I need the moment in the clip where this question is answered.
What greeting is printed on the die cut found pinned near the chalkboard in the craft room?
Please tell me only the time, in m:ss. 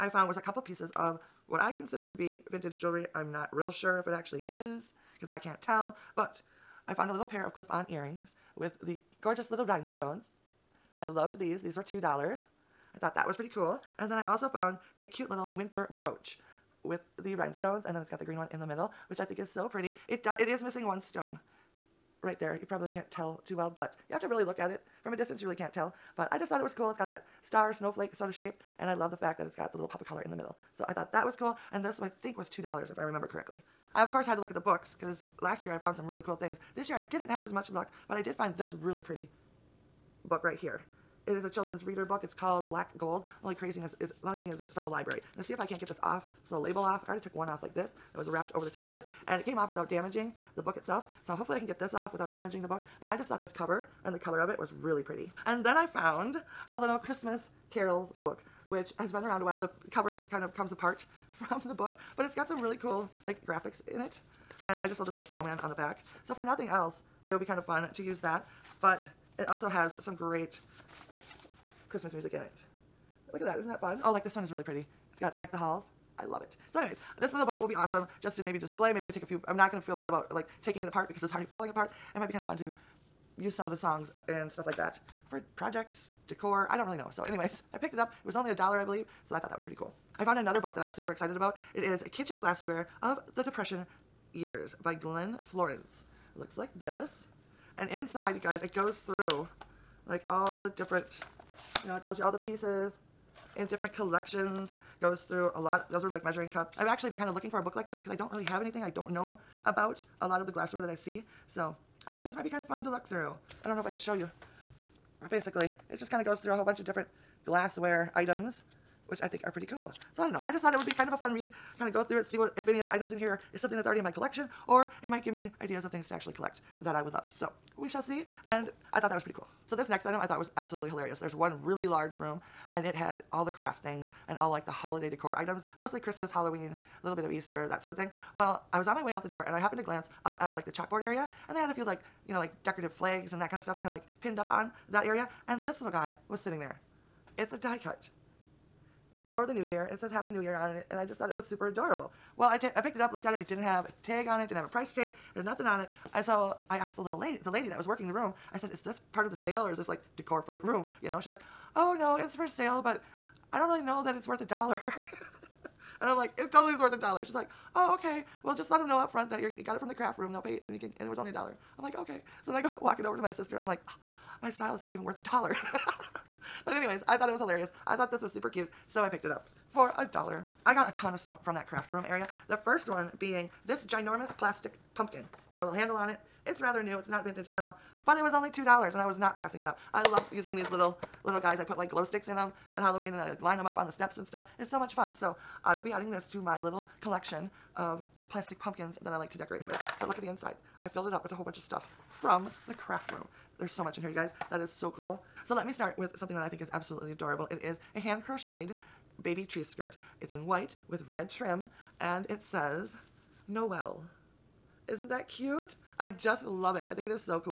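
2:30.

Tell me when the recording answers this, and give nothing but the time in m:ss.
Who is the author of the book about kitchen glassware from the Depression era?
1:34.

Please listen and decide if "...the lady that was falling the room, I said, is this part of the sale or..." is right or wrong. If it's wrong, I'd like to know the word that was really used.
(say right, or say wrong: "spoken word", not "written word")
wrong: "working", not "falling".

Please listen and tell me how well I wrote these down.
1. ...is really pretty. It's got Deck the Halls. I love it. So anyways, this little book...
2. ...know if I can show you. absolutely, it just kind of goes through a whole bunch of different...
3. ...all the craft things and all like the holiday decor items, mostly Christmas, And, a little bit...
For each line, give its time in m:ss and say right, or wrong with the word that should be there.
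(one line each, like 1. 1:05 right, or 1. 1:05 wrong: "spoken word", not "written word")
1. 1:14 right
2. 1:53 wrong: "basically", not "absolutely"
3. 2:13 wrong: "Halloween", not "And".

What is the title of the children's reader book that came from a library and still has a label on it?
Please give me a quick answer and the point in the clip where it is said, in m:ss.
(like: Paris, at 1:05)
Black Gold, at 0:42.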